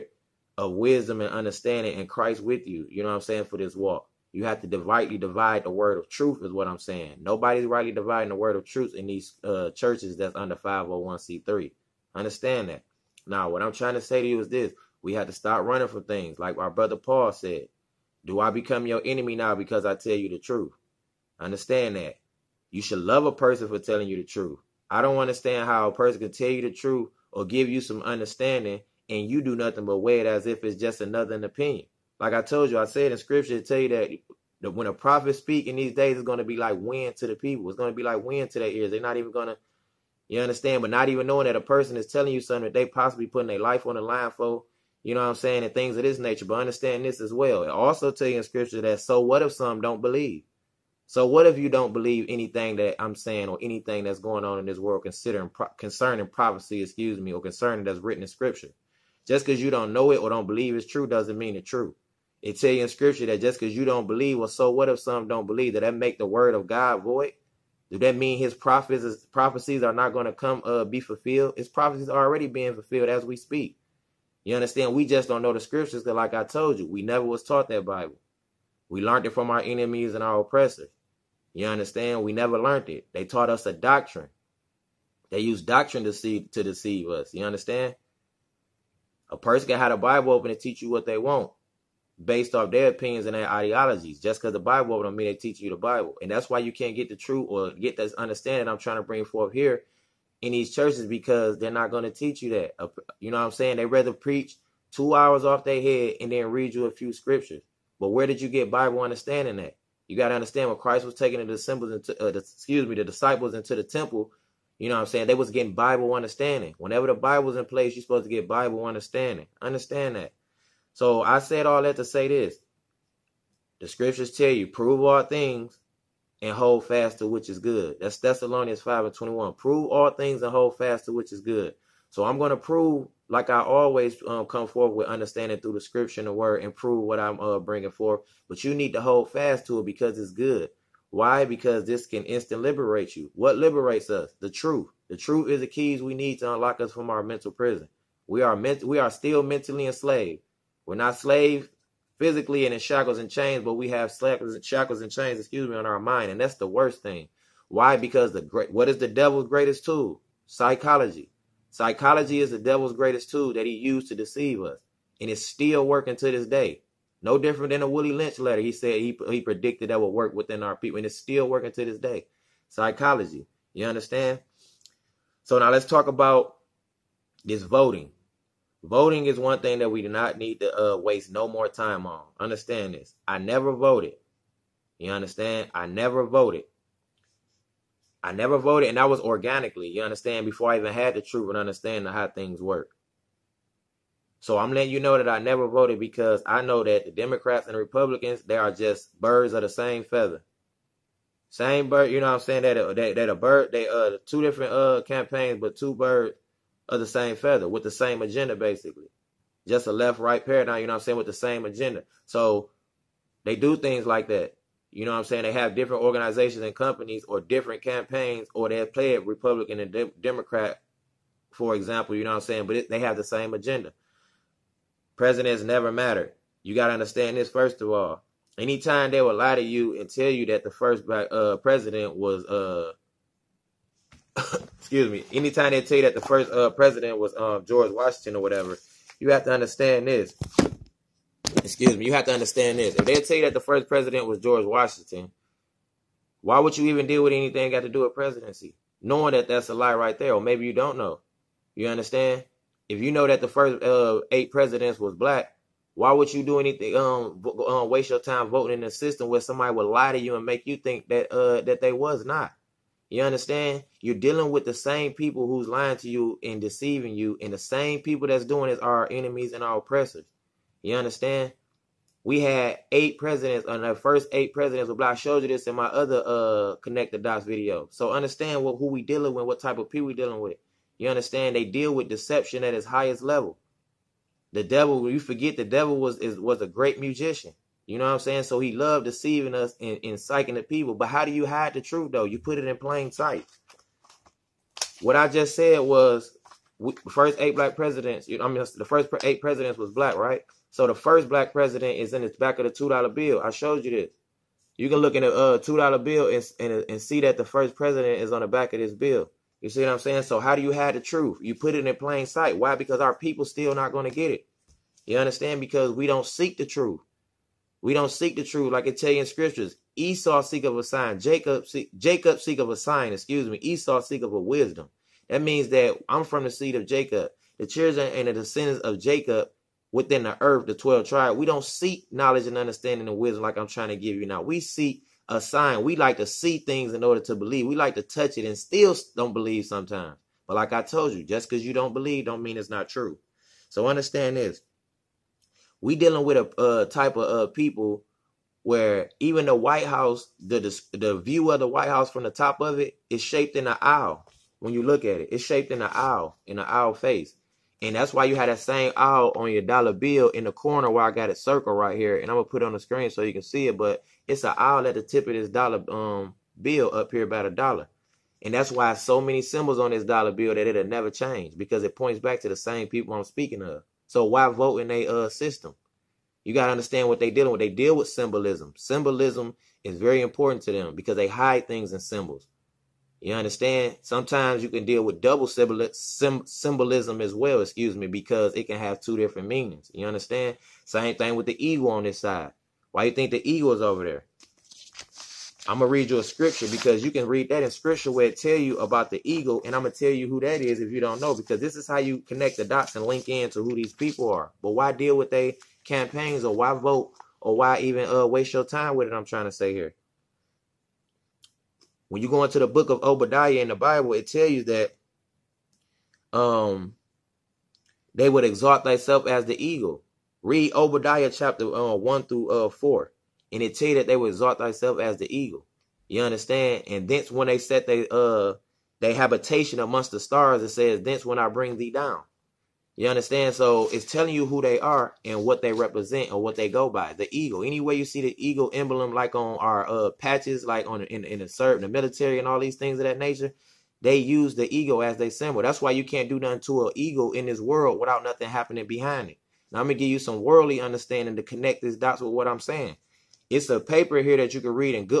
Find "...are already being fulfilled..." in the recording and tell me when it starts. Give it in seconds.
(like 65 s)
72 s.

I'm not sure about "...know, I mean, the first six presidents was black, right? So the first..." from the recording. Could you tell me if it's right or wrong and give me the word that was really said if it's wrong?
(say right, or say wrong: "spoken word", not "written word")
wrong: "eight", not "six".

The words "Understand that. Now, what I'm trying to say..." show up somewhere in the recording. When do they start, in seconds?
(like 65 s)
12 s.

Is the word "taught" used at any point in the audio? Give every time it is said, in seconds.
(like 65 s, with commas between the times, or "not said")
77 s, 83 s.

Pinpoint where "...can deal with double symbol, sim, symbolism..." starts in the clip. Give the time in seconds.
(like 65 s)
384 s.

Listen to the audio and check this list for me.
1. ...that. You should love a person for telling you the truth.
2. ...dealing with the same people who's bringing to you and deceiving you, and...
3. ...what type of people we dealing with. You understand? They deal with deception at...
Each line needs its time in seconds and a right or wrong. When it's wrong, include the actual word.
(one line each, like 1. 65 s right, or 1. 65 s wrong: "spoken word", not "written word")
1. 21 s right
2. 264 s wrong: "lying", not "bringing"
3. 279 s right.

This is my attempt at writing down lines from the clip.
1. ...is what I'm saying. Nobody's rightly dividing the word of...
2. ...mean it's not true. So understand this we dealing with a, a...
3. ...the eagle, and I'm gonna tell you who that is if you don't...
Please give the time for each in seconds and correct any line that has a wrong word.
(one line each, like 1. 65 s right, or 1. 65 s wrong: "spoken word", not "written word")
1. 6 s right
2. 342 s right
3. 399 s right.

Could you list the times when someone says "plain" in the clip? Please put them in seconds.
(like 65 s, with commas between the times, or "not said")
292 s, 311 s.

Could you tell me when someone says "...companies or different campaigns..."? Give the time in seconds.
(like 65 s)
216 s.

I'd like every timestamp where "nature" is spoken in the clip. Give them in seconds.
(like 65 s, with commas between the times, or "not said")
46 s, 443 s.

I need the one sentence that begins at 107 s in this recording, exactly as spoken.
But where did you get Bible understanding at?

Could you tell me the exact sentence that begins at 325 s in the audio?
That means that I'm from the seed of Jacob.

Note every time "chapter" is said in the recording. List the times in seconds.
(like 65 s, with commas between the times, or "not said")
421 s.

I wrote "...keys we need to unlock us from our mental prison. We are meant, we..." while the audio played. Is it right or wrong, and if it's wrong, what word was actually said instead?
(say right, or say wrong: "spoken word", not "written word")
right.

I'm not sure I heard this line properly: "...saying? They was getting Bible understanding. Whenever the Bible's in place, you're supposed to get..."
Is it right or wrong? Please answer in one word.
right.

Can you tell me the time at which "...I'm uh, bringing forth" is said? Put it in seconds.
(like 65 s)
137 s.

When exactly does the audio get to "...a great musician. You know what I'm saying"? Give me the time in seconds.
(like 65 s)
286 s.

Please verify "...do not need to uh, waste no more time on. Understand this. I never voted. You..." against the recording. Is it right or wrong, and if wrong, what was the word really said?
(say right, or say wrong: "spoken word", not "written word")
right.